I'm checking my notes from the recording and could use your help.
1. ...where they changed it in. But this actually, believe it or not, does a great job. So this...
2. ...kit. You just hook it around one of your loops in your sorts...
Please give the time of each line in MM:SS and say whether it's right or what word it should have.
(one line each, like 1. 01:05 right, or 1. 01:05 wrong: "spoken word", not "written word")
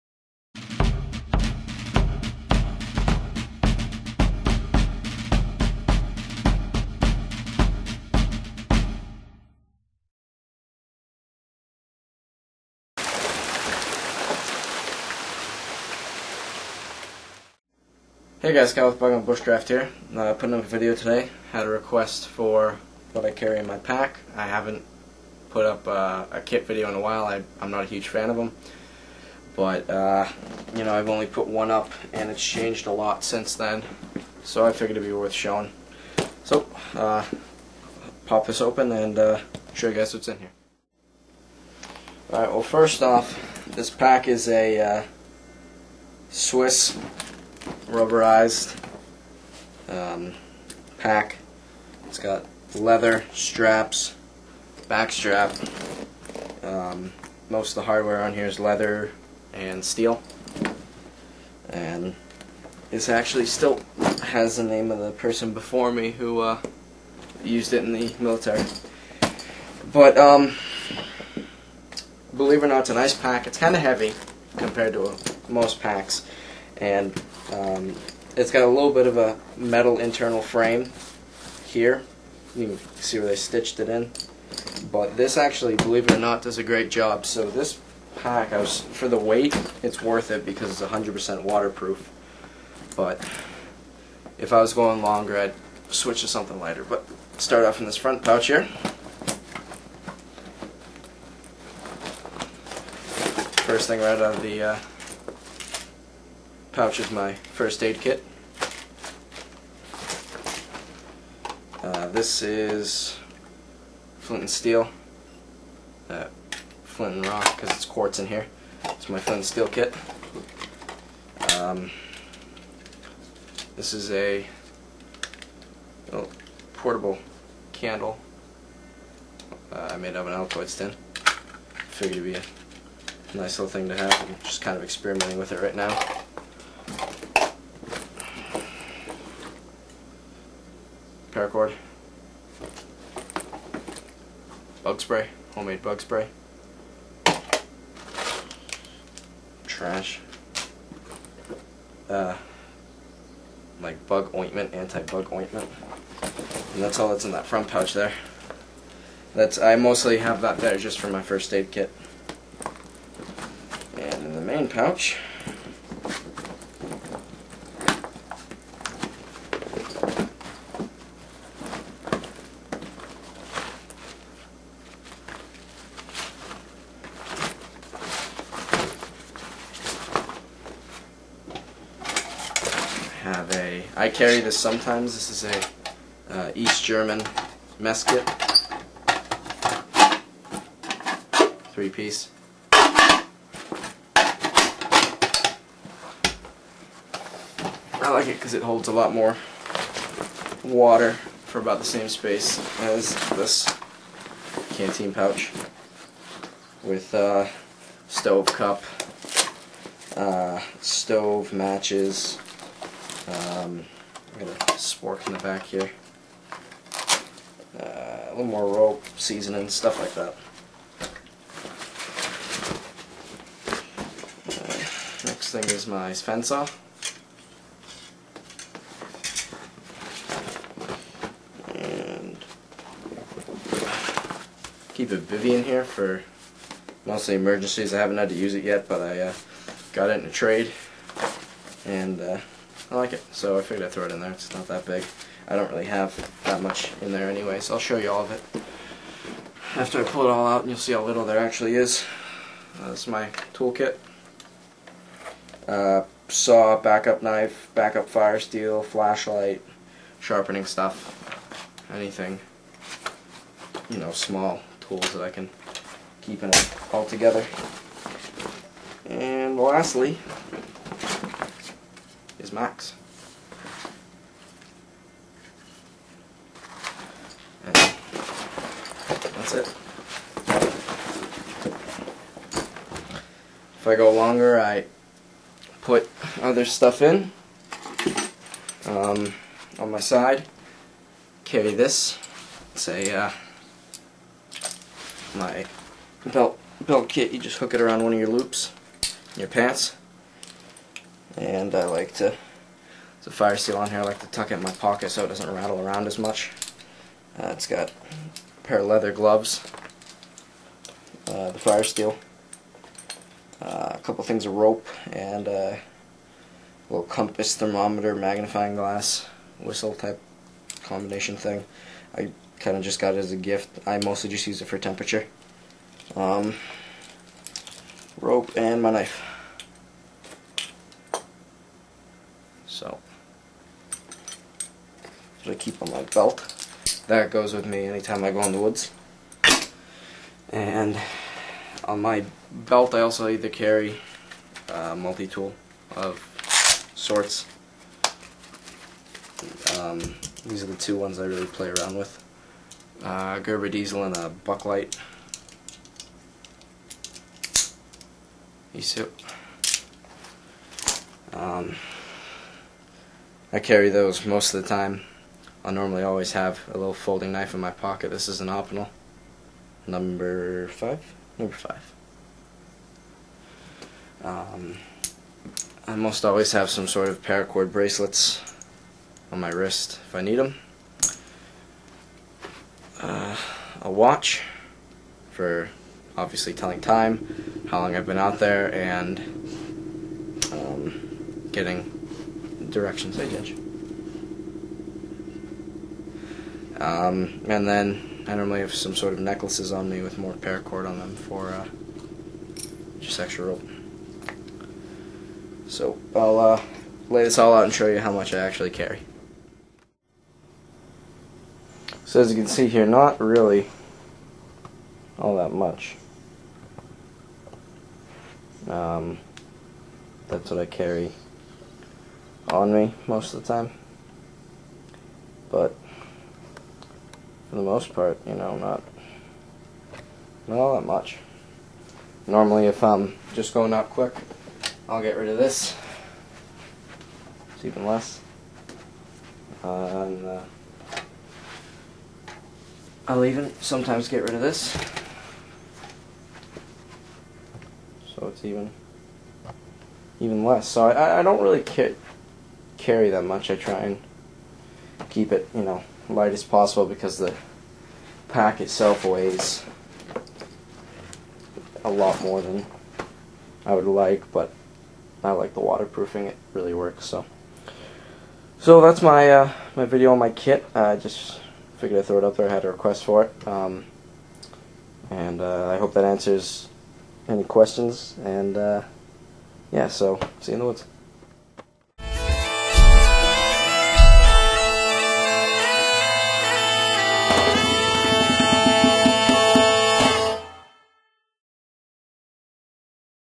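1. 01:23 wrong: "stitched", not "changed"
2. 04:57 wrong: "pants", not "sorts".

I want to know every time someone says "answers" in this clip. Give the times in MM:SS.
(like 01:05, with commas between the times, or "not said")
07:56.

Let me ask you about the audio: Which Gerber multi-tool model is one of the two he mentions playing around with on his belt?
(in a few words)
Gerber Diesel.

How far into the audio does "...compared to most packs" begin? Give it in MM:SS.
01:14.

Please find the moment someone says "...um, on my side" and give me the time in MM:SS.
04:48.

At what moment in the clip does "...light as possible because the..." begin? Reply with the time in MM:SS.
07:36.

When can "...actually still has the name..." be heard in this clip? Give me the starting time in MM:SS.
01:03.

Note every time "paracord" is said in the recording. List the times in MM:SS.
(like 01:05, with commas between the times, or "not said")
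02:21, 06:17, 06:40.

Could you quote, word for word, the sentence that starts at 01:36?
But start off in this front pouch here.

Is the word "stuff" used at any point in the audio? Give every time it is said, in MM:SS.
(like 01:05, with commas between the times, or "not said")
03:39, 04:20, 04:46.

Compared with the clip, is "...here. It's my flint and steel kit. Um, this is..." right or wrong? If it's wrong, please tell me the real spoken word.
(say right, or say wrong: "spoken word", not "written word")
right.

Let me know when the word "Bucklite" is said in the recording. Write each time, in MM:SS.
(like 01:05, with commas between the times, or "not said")
05:54.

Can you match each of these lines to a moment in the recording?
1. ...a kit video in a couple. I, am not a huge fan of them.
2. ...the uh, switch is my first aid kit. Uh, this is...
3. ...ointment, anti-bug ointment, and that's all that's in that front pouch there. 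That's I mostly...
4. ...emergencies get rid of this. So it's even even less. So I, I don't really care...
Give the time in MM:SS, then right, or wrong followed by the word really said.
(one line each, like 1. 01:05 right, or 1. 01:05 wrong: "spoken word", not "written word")
1. 00:26 wrong: "while", not "couple"
2. 01:44 wrong: "pouch", not "switch"
3. 02:34 right
4. 07:23 wrong: "sometimes", not "emergencies".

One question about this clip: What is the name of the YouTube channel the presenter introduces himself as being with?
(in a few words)
Bygone Bushcraft.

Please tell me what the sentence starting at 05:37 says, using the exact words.
That goes with me anytime I go in the woods.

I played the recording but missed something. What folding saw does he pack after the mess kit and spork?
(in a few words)
Sven saw.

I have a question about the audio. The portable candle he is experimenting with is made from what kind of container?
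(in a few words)
An Altoid tin.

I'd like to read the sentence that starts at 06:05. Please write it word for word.
I normally always have a little folding knife in my pocket.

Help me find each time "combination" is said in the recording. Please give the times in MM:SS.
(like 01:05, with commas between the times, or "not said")
05:20.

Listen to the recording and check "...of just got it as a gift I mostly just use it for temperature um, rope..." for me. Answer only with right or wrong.
right.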